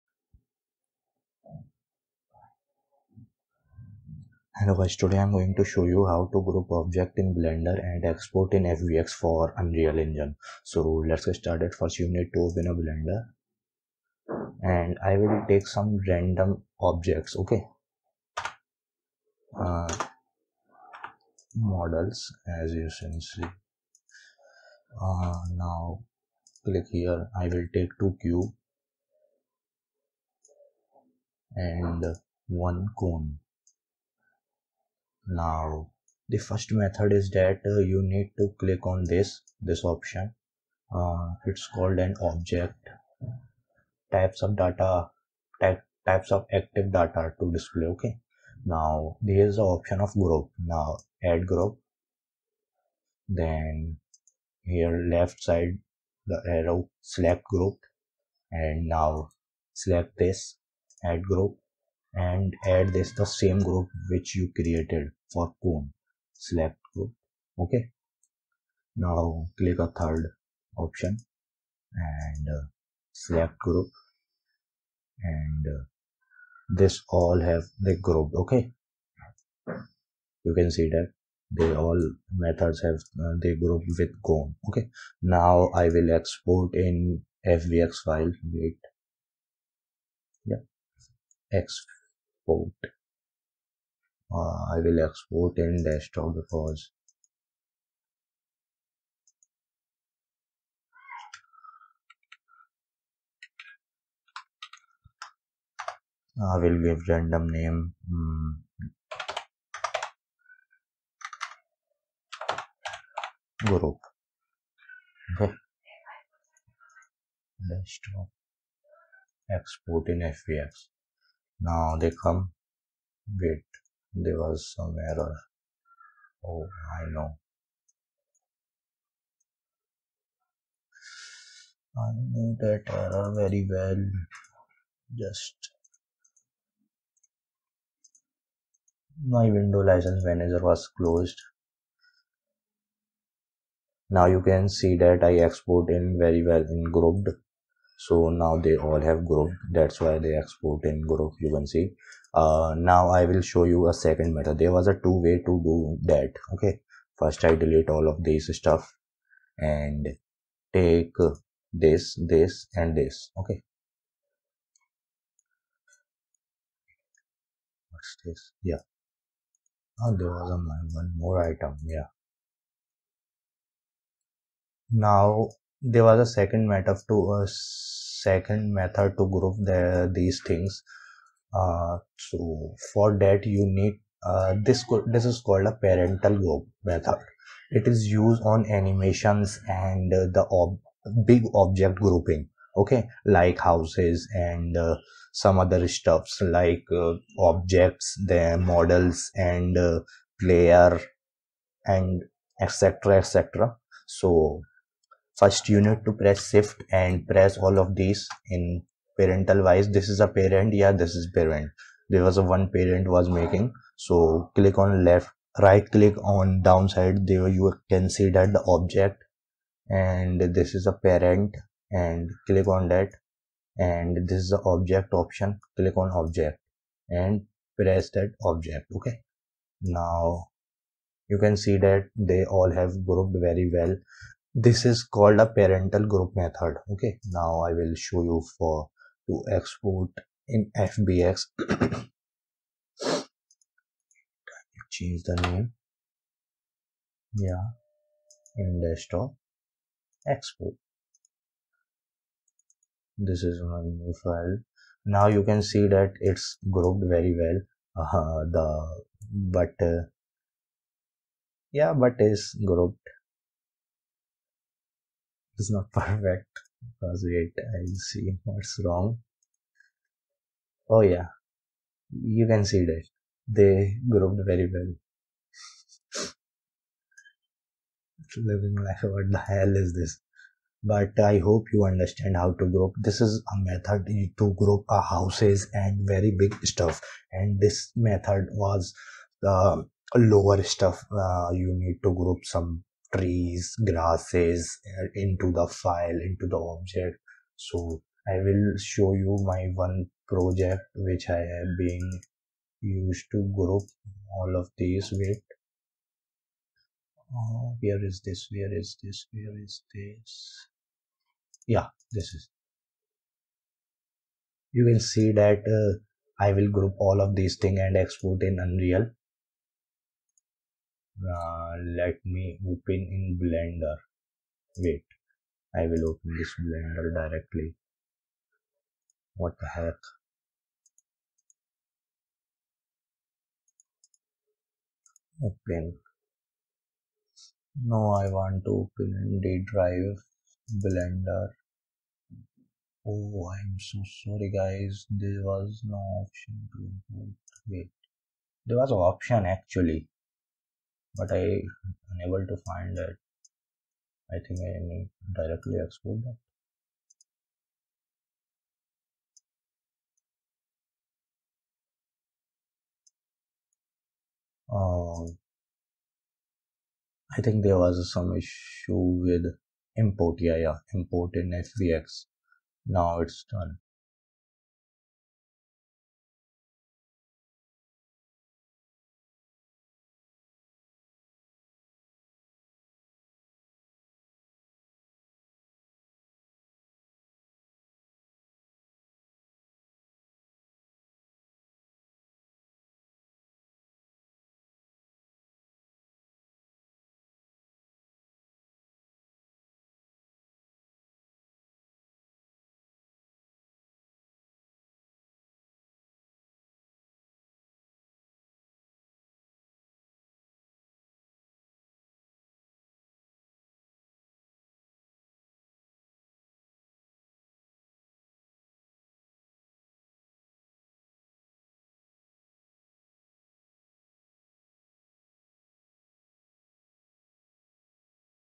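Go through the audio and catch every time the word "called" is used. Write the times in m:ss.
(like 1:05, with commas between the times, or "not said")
0:41, 3:05, 3:55.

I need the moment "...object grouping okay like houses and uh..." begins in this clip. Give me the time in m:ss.
3:11.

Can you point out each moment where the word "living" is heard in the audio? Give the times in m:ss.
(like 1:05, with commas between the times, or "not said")
4:38.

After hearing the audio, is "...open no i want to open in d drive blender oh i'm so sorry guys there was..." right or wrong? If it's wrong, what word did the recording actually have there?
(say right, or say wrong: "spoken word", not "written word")
right.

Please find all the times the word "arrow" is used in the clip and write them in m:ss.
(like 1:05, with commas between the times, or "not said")
0:56.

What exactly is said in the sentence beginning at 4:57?
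So I will show you my one project which I have been used to group all of these with.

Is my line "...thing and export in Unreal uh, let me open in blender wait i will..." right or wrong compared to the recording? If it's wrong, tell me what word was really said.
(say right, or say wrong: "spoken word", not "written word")
right.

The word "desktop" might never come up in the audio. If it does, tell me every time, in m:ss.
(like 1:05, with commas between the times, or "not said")
1:35, 1:57, 4:08.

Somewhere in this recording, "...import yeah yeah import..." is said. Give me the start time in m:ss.
6:09.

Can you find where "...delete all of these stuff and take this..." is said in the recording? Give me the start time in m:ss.
2:37.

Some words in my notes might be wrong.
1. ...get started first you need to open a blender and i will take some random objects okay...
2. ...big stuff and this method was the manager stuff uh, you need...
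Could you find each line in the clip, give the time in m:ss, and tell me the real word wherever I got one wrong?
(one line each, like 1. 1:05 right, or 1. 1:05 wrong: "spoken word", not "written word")
1. 0:11 right
2. 4:46 wrong: "lower", not "manager".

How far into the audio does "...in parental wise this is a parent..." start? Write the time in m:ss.
3:28.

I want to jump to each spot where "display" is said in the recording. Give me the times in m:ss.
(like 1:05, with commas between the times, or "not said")
0:47.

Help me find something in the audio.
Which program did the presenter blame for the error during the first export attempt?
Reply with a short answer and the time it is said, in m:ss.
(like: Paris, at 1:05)
window license manager, at 2:19.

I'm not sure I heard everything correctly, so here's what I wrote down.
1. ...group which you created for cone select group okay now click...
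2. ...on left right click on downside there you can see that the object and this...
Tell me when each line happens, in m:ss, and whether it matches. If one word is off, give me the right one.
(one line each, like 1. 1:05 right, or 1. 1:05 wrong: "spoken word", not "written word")
1. 1:03 right
2. 3:34 right.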